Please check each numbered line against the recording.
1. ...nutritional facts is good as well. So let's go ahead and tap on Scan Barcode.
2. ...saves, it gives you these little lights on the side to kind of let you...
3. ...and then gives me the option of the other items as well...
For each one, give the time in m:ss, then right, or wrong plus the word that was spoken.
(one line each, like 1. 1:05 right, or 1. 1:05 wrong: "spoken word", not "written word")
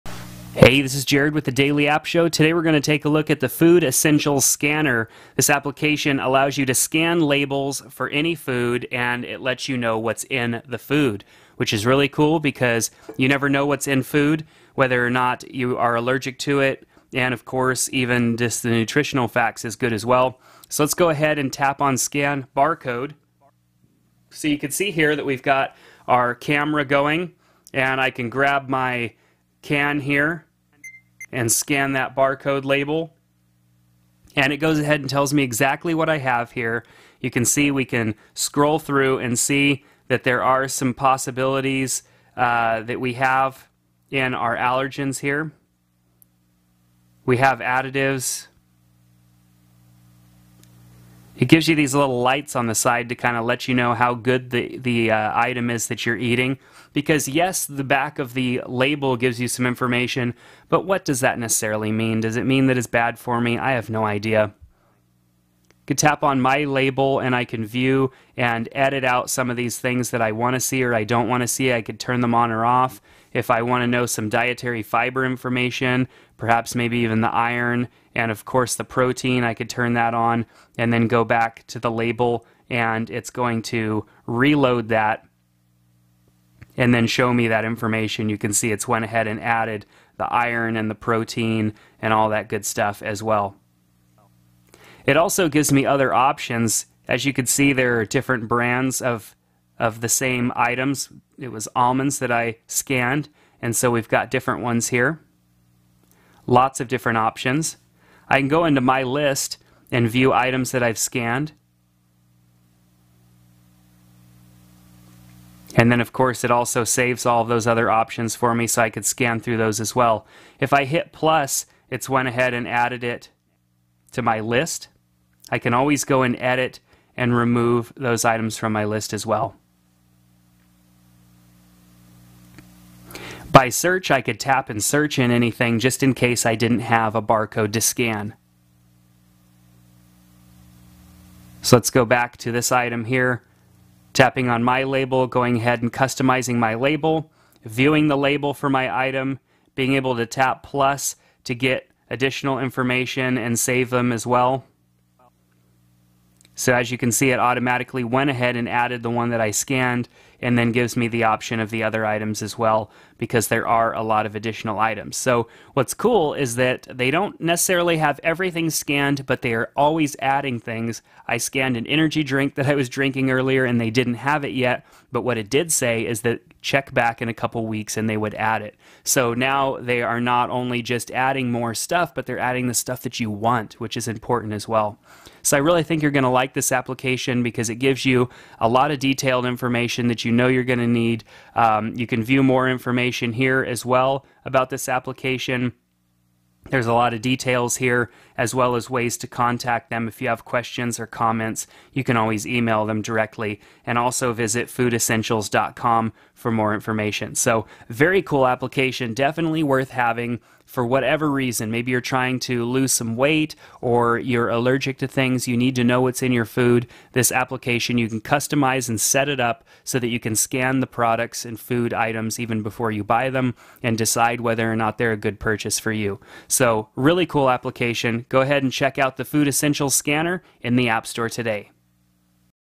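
1. 0:18 right
2. 0:47 wrong: "additives", not "saves"
3. 2:40 right.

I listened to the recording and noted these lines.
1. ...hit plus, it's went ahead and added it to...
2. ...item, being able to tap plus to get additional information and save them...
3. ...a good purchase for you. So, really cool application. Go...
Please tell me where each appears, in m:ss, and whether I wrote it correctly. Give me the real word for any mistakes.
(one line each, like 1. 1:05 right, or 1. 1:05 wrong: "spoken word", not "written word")
1. 2:00 right
2. 2:29 right
3. 3:45 right.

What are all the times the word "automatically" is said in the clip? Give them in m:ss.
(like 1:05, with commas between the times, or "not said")
2:37.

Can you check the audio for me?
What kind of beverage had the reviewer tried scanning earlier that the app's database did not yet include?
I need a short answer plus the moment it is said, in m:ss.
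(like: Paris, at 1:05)
An energy drink, at 2:51.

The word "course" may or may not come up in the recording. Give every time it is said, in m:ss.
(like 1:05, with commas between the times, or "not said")
0:17, 1:18, 1:56.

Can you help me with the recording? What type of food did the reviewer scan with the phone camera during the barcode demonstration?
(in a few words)
Almonds.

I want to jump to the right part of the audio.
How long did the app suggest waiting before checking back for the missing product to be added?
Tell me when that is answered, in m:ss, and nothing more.
2:57.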